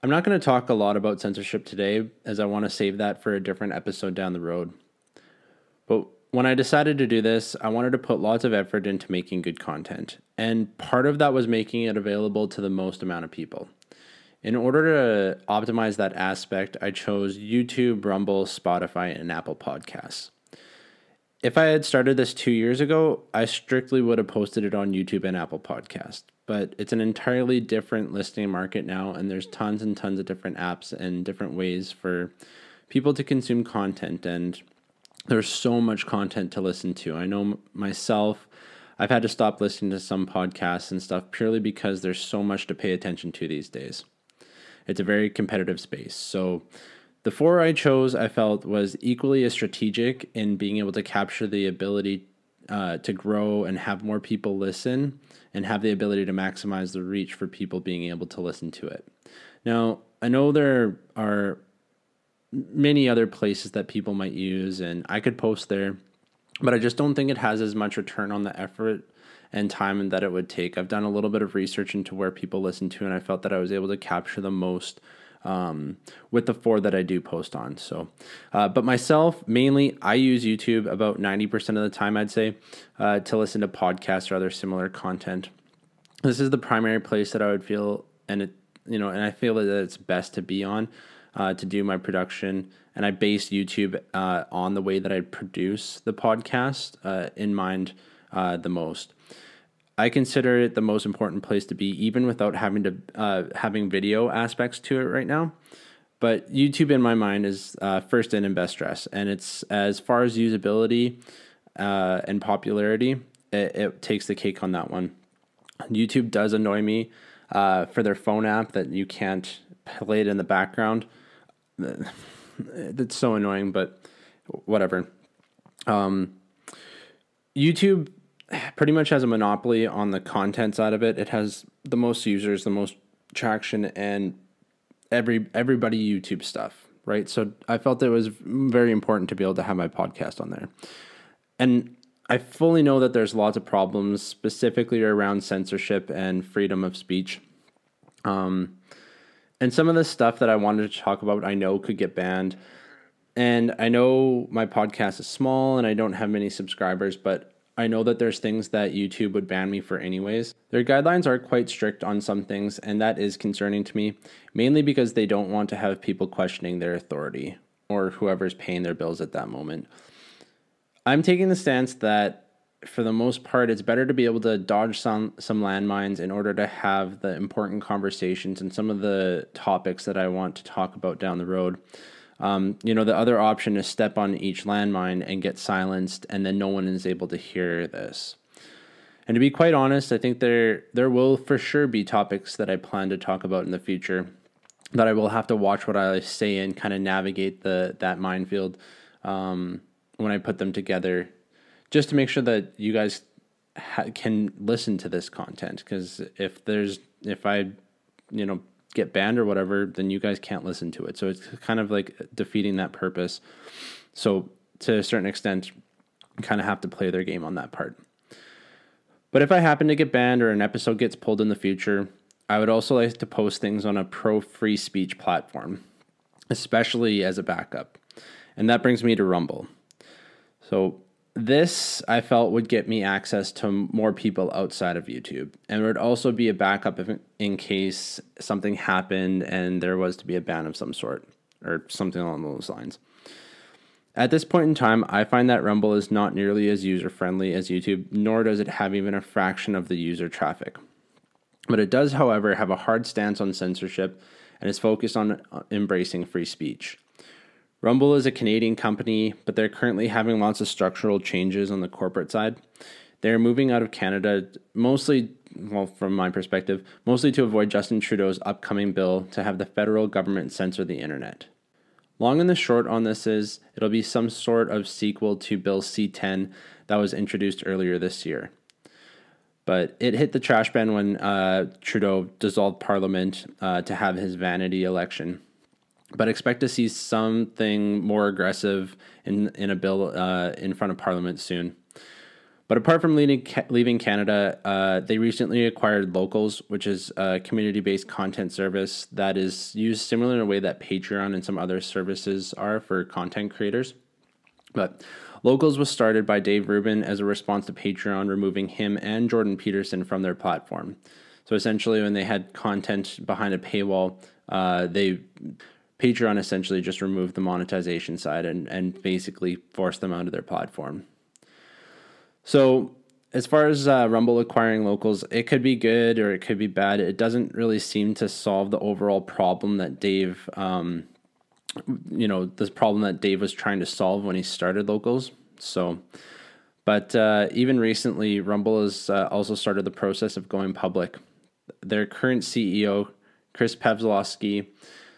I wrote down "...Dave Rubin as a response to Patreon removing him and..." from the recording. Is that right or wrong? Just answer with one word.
right.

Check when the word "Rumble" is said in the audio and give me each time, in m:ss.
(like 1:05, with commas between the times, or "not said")
0:18, 3:49, 4:05, 4:17, 5:24, 5:38.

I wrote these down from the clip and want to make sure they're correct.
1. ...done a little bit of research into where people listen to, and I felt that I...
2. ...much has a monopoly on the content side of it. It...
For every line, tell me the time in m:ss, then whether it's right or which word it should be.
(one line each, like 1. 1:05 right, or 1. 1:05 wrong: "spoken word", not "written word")
1. 1:10 right
2. 2:08 right.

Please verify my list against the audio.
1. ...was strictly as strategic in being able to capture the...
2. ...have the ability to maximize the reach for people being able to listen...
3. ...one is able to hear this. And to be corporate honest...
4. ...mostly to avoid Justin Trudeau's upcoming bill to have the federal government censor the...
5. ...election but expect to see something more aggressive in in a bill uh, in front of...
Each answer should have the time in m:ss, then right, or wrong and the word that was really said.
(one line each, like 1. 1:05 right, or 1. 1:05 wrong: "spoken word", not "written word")
1. 0:48 wrong: "equally", not "strictly"
2. 0:55 right
3. 3:06 wrong: "quite", not "corporate"
4. 4:27 right
5. 4:44 right.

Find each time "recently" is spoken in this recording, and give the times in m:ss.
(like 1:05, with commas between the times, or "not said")
4:55, 5:37.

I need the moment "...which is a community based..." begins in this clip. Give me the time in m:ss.
4:56.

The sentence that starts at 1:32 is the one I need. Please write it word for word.
And I base YouTube uh, on the way that I produce the podcast uh, in mind uh, the most.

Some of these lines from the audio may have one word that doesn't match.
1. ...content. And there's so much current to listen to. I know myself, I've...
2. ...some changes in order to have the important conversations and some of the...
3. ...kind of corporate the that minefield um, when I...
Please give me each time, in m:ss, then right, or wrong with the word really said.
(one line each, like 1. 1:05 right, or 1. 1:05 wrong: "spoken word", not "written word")
1. 0:33 wrong: "content", not "current"
2. 2:55 wrong: "landmines", not "changes"
3. 3:16 wrong: "navigate", not "corporate".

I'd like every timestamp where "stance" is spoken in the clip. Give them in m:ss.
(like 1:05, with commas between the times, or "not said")
2:51, 4:13.